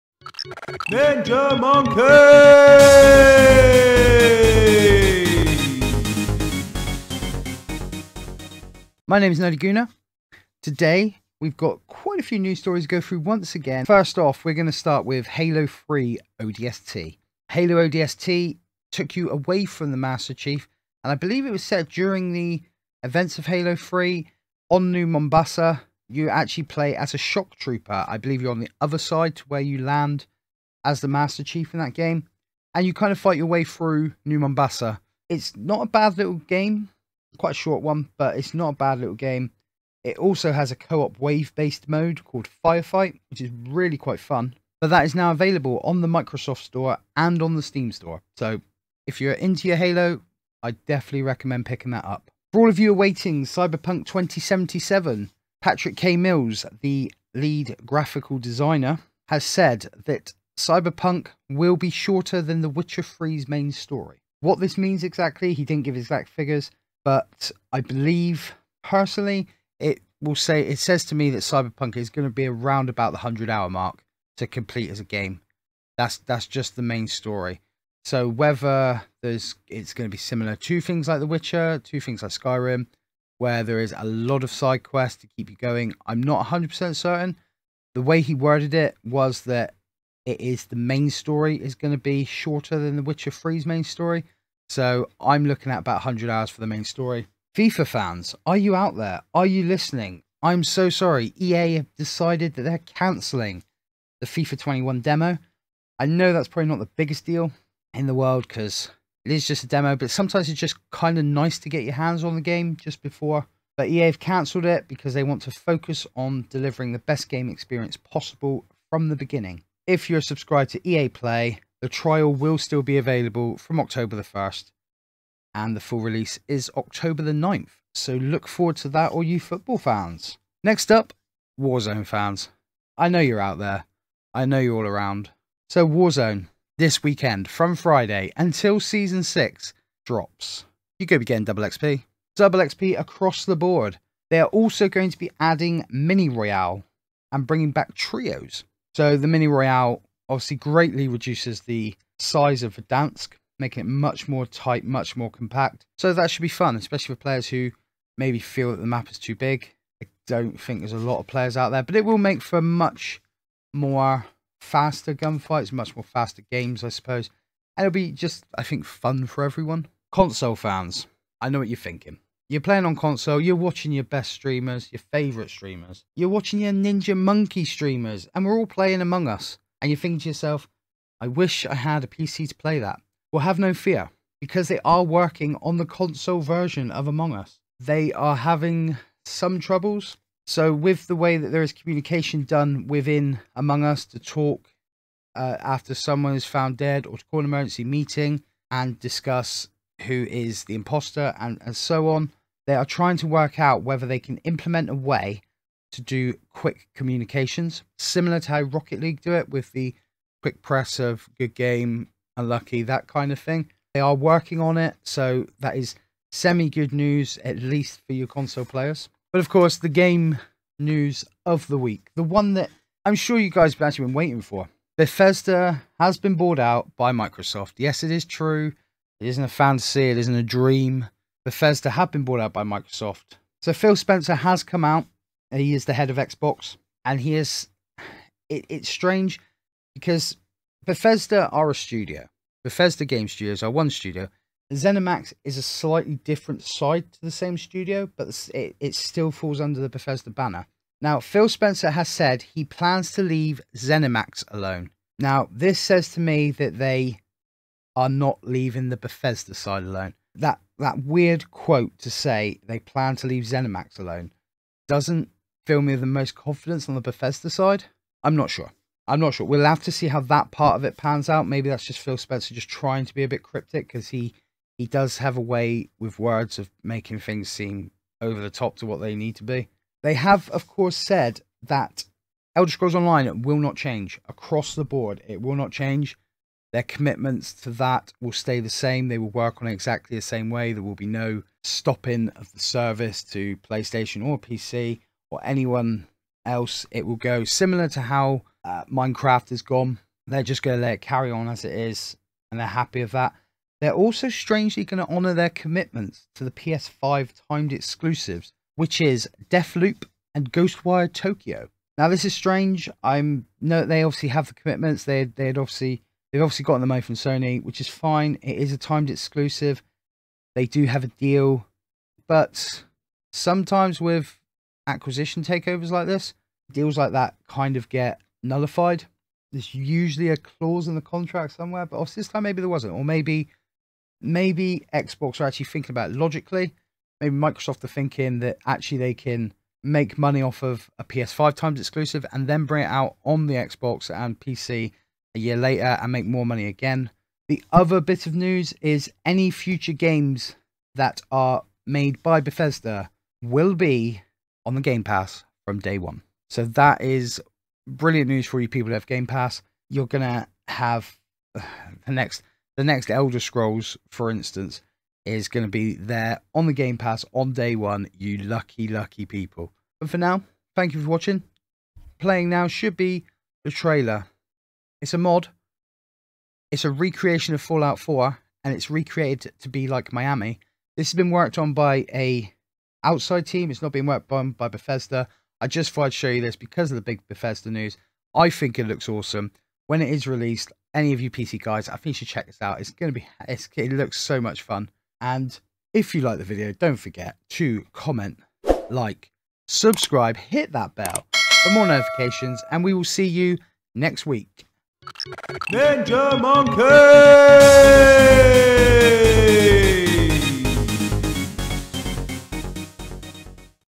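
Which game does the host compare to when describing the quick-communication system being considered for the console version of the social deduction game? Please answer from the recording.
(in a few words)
Rocket League.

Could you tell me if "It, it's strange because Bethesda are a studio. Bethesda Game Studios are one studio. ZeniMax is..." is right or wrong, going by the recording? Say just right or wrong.
right.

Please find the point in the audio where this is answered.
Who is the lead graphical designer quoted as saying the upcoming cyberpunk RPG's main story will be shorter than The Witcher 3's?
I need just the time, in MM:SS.
00:55.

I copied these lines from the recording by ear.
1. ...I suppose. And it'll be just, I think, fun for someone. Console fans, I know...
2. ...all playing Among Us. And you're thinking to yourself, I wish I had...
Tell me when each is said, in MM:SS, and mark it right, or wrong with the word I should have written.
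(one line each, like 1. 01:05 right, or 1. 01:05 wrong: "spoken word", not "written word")
1. 02:46 wrong: "everyone", not "someone"
2. 02:58 right.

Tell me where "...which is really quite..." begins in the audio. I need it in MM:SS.
00:43.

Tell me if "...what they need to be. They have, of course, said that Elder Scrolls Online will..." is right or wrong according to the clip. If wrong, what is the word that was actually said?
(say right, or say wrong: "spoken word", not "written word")
right.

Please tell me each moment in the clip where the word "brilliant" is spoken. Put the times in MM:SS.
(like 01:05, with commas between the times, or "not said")
05:57.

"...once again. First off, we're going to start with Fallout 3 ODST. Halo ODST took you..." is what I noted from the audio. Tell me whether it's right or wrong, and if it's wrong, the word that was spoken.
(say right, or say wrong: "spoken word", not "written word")
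wrong: "Halo", not "Fallout".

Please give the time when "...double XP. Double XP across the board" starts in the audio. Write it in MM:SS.
02:21.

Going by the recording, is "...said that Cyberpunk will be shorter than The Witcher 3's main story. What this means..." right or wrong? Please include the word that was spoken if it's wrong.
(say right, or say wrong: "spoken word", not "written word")
right.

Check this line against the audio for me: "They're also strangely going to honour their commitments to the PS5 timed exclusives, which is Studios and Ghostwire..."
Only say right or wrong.
wrong.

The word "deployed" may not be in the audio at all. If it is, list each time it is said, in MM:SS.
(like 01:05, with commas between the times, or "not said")
not said.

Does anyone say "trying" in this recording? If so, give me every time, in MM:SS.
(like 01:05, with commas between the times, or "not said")
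03:22, 04:32.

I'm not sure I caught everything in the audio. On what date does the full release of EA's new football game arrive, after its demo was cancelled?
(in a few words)
October 9th.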